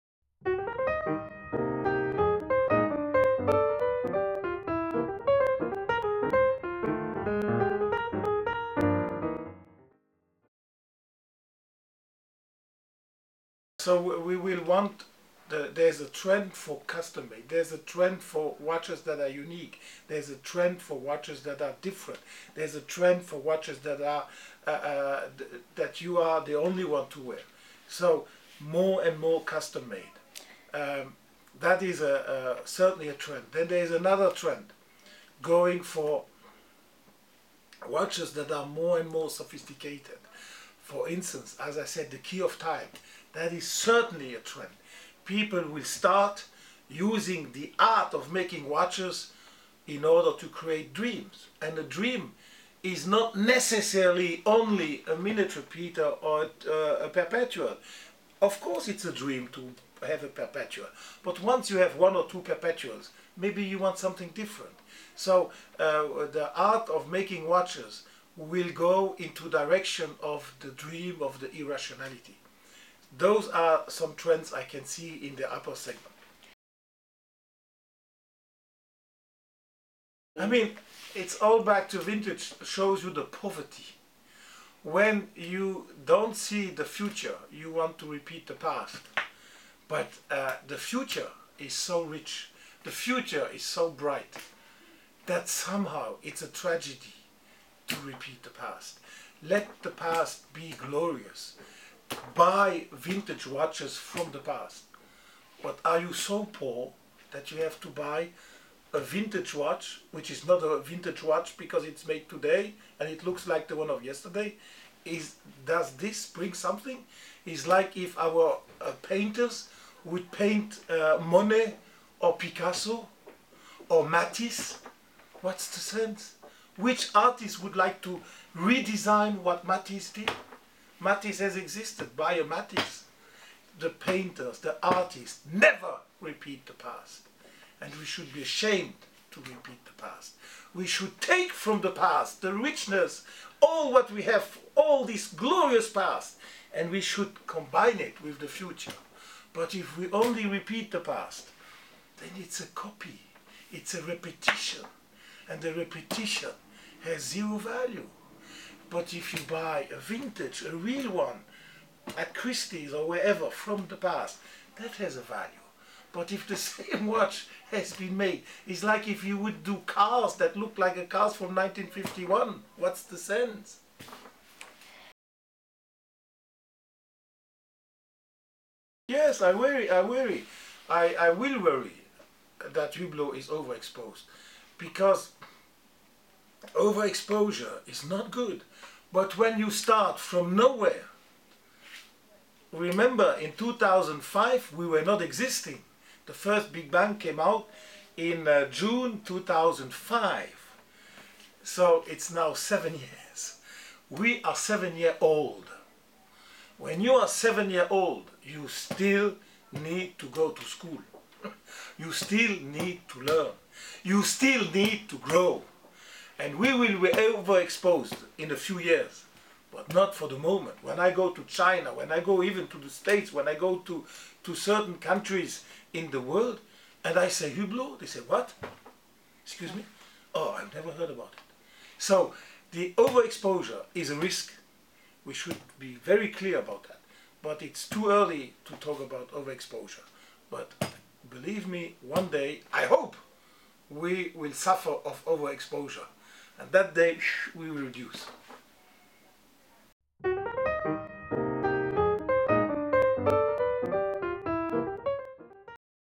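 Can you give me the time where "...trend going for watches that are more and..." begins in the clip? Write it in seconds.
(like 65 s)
34 s.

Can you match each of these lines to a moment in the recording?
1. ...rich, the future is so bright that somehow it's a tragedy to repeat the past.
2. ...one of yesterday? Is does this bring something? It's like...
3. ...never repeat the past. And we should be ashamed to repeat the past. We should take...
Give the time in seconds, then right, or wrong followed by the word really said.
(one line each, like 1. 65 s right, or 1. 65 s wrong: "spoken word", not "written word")
1. 92 s right
2. 113 s right
3. 135 s right.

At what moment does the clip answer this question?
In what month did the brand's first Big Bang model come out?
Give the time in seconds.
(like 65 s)
198 s.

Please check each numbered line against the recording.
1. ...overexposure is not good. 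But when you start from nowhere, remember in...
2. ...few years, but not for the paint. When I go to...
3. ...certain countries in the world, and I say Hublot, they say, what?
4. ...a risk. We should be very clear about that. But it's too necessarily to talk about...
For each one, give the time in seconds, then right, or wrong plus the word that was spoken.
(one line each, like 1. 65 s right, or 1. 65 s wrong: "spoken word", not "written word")
1. 186 s right
2. 218 s wrong: "moment", not "paint"
3. 224 s right
4. 234 s wrong: "early", not "necessarily".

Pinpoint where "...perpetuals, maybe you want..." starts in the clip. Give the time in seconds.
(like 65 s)
62 s.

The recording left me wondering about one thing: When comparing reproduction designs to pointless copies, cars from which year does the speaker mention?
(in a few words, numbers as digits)
1951.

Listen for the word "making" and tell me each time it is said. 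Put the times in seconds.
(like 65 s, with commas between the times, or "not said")
48 s, 67 s.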